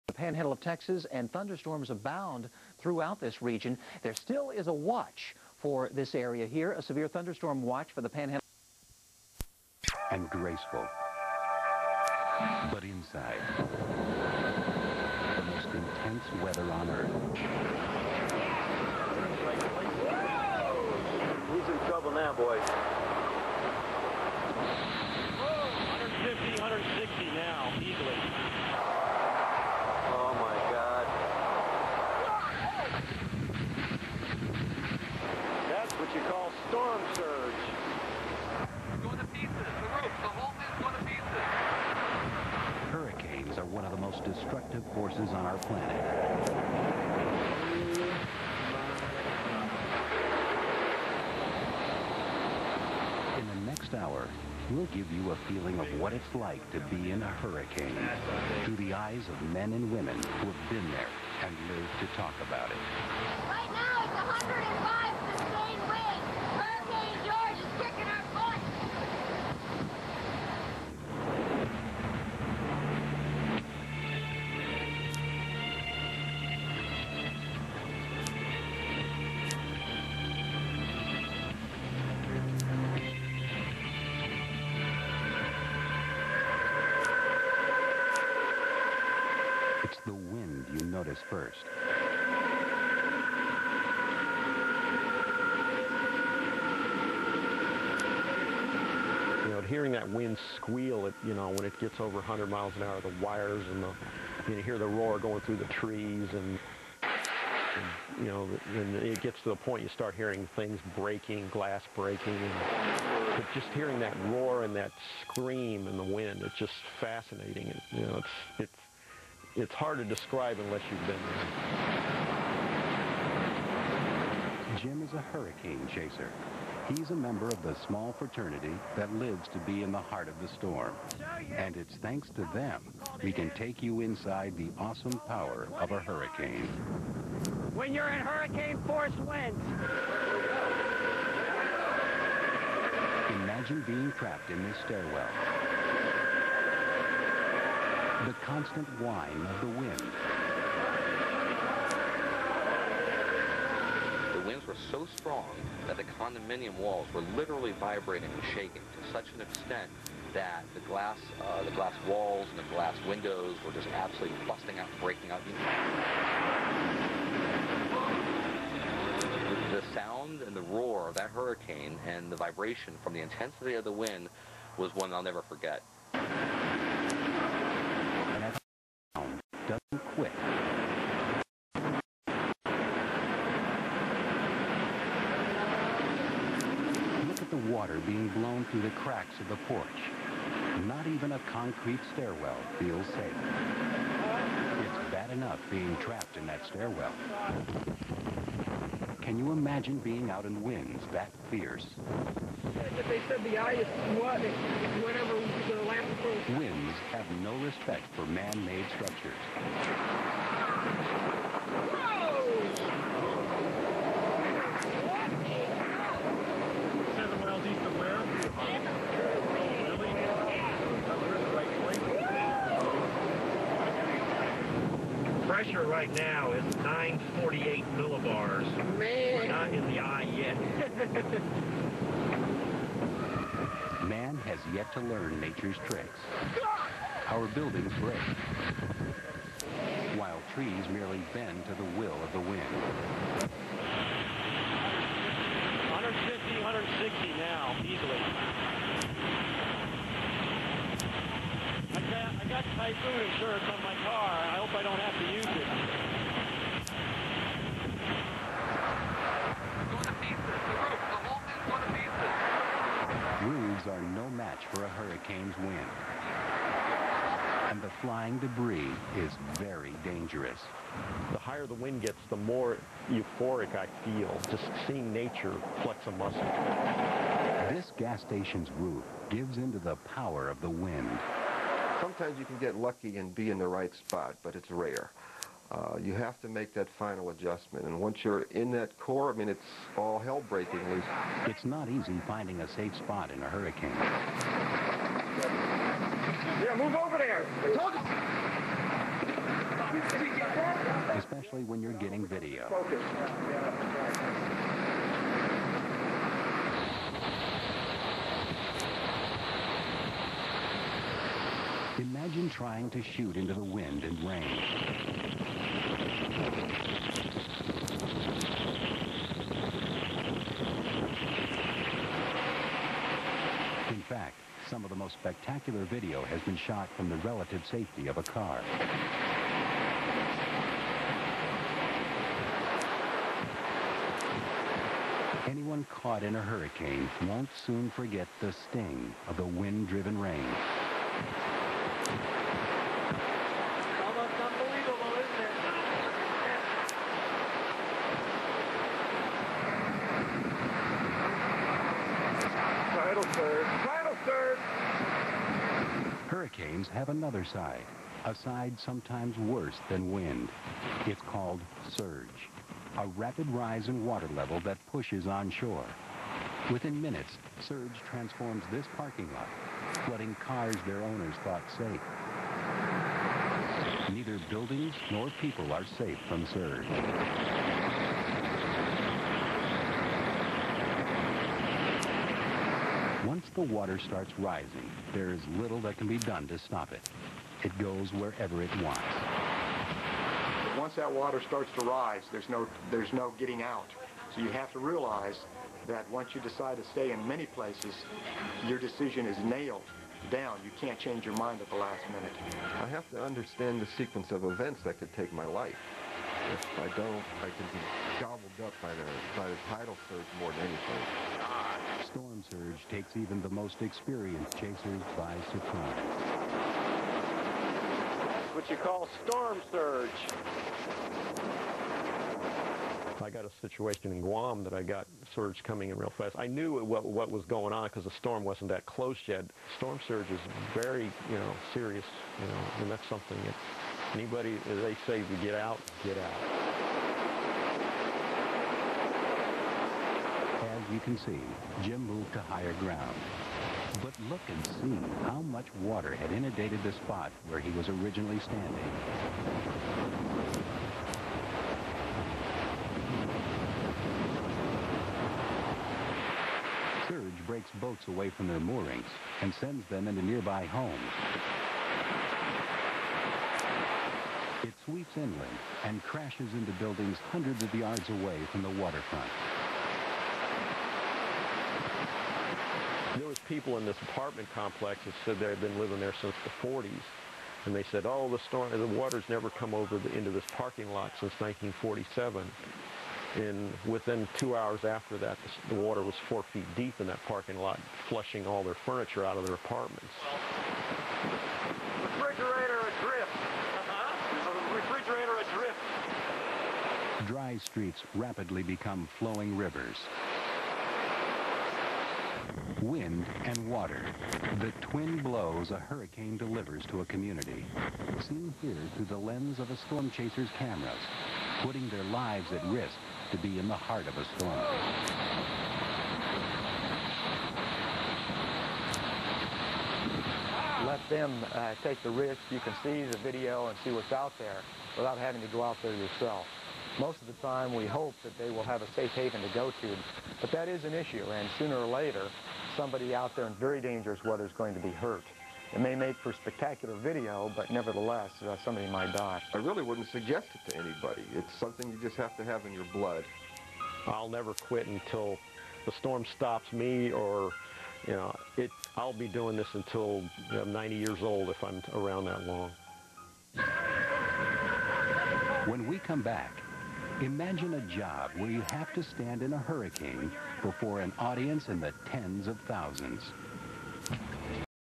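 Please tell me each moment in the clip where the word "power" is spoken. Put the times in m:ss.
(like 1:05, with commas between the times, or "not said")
2:15, 4:40.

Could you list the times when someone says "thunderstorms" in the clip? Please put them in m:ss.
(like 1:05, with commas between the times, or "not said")
0:01, 0:07.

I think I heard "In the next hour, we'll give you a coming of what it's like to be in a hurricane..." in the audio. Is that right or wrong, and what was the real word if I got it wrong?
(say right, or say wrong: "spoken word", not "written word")
wrong: "feeling", not "coming".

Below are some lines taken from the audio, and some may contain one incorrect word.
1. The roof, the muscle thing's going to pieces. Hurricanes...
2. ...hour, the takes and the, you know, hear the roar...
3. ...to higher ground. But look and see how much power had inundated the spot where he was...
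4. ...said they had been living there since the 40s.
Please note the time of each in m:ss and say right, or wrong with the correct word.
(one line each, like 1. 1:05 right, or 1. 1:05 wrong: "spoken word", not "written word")
1. 0:39 wrong: "whole", not "muscle"
2. 1:42 wrong: "wires", not "takes"
3. 7:22 wrong: "water", not "power"
4. 7:55 right.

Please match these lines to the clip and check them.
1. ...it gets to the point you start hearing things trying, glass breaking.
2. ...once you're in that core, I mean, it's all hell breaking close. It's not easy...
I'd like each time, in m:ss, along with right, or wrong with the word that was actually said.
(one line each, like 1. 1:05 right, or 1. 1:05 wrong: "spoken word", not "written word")
1. 1:48 wrong: "breaking", not "trying"
2. 4:48 wrong: "loose", not "close".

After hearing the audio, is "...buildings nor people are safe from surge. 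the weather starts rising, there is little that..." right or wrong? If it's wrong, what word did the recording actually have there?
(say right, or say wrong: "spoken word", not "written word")
wrong: "water", not "weather".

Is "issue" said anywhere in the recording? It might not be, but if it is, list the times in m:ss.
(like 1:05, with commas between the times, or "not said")
8:50.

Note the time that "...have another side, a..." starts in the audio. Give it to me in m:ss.
5:56.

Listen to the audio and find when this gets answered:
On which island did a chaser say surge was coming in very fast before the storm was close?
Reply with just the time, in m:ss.
7:04.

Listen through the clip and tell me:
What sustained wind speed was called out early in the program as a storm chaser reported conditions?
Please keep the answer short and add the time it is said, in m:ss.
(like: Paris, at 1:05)
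105, at 1:04.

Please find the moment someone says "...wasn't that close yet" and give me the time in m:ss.
7:08.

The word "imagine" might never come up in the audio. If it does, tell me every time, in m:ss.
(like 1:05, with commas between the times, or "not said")
2:23, 3:19, 5:12, 9:17.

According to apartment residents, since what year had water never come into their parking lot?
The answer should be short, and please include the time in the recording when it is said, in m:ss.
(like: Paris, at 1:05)
1947, at 8:01.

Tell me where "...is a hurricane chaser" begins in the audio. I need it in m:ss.
2:05.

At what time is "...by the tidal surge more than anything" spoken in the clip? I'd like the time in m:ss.
6:49.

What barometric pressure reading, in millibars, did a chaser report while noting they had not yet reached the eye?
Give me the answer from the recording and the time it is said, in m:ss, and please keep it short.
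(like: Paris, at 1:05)
948 millibars, at 3:46.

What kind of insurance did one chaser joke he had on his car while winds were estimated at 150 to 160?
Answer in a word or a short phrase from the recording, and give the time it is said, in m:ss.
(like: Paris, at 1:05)
typhoon insurance, at 4:12.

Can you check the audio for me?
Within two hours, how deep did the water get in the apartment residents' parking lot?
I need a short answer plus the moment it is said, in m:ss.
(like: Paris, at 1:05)
4 feet, at 8:06.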